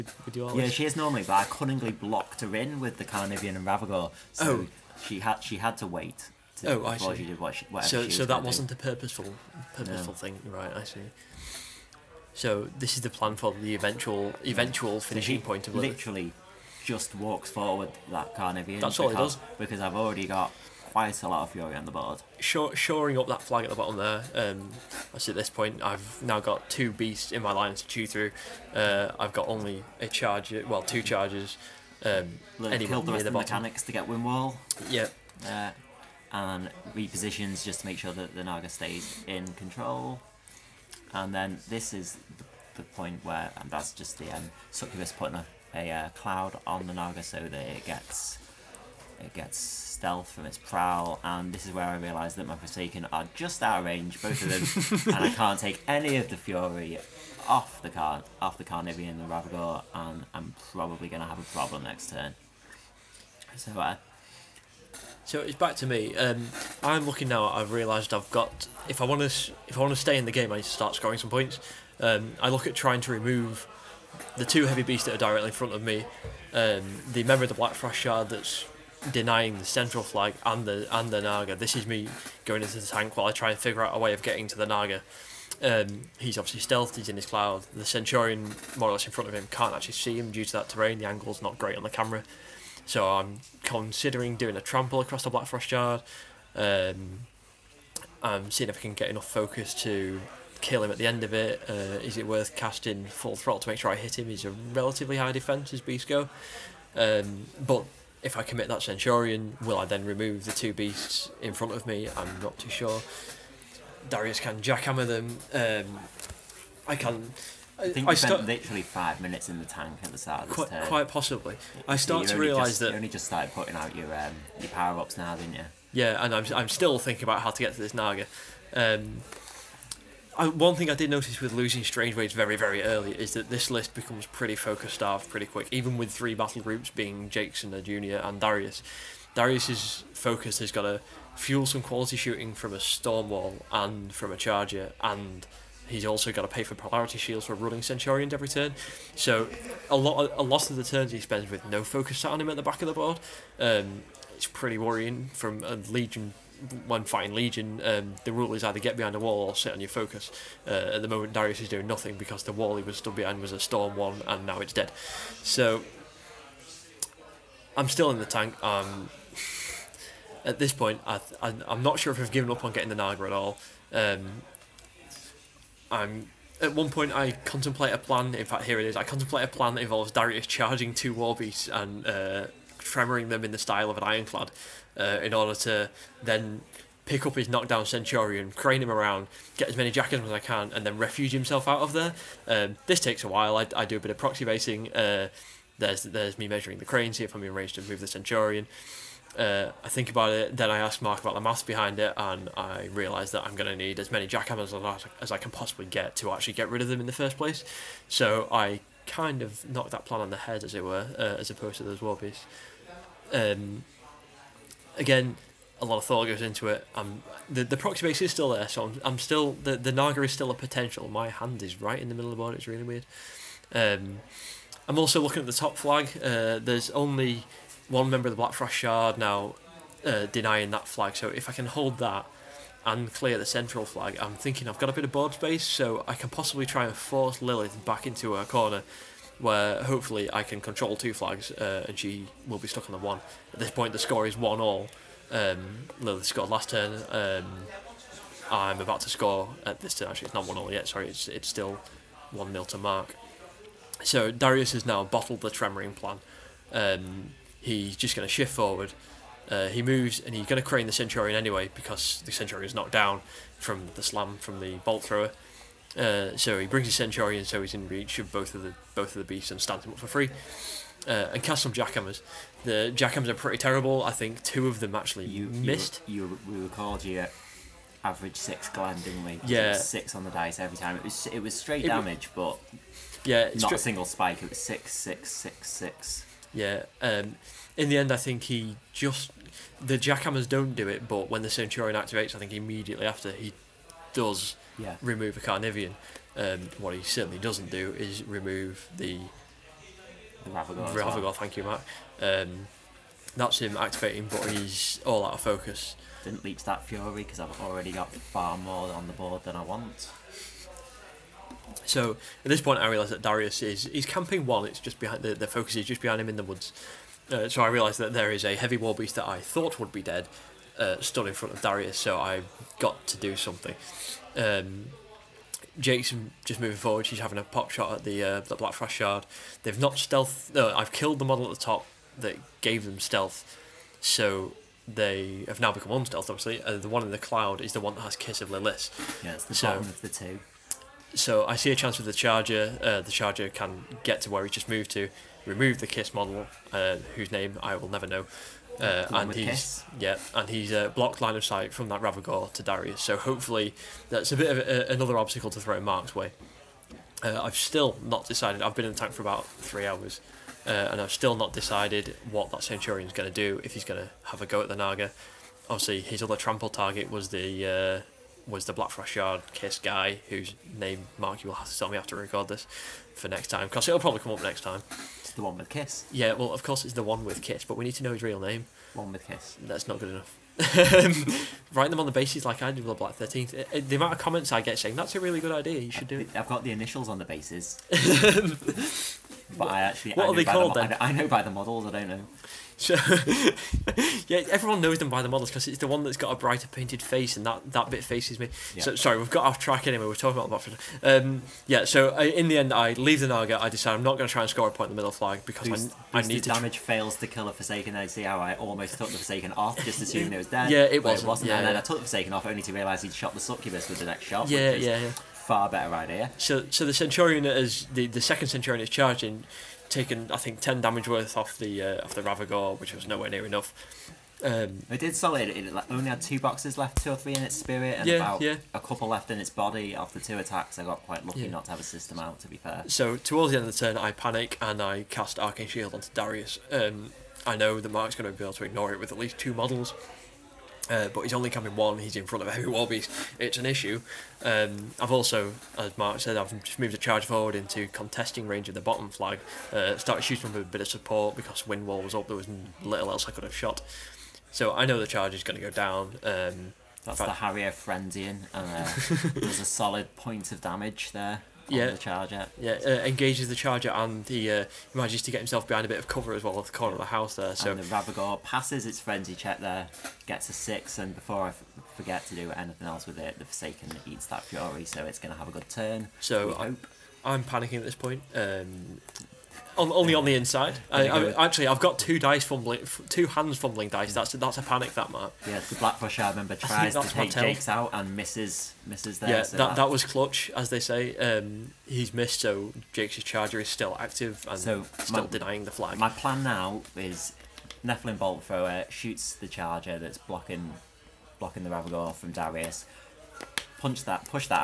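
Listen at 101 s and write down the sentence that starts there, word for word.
Uh, is it worth casting full throttle to make sure I hit him?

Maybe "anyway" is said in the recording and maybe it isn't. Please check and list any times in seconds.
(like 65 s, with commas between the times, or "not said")
261 s, 399 s.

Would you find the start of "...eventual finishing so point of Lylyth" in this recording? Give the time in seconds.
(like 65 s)
14 s.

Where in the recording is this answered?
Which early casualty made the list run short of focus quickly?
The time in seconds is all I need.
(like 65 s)
131 s.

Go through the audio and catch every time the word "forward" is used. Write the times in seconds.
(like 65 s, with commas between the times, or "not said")
17 s, 258 s, 326 s, 447 s.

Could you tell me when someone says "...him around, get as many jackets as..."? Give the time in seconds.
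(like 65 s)
188 s.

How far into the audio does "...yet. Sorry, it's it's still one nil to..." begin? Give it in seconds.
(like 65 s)
250 s.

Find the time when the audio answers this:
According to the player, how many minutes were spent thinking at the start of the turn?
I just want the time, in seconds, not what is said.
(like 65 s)
118 s.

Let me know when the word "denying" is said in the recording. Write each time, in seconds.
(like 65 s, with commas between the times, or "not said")
79 s, 230 s, 495 s.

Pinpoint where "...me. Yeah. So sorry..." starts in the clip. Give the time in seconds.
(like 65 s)
398 s.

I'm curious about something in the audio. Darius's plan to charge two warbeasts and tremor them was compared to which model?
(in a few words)
Ironclad.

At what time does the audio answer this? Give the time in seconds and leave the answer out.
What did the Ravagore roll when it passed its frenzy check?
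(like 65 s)
470 s.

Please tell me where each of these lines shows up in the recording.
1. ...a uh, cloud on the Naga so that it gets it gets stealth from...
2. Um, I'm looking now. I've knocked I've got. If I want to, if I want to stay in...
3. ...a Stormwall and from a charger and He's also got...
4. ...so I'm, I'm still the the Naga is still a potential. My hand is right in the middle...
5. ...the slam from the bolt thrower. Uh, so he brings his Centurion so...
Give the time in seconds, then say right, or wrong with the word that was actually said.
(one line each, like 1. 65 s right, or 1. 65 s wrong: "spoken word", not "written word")
1. 45 s right
2. 66 s wrong: "realised", not "knocked"
3. 142 s right
4. 218 s right
5. 263 s right.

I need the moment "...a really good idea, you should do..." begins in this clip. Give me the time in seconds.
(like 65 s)
385 s.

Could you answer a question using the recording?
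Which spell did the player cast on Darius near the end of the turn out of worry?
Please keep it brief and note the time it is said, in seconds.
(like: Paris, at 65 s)
Arcane Shield, at 435 s.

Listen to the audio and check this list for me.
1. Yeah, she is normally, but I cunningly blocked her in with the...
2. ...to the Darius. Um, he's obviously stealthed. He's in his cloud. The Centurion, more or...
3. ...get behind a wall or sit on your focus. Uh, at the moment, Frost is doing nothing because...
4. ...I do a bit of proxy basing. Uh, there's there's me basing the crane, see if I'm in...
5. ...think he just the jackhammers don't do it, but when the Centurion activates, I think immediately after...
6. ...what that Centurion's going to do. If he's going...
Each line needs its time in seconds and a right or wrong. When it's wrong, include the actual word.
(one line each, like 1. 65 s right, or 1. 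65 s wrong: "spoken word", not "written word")
1. 0 s right
2. 84 s wrong: "Naga", not "Darius"
3. 158 s wrong: "Darius", not "Frost"
4. 193 s wrong: "measuring", not "basing"
5. 288 s right
6. 362 s right.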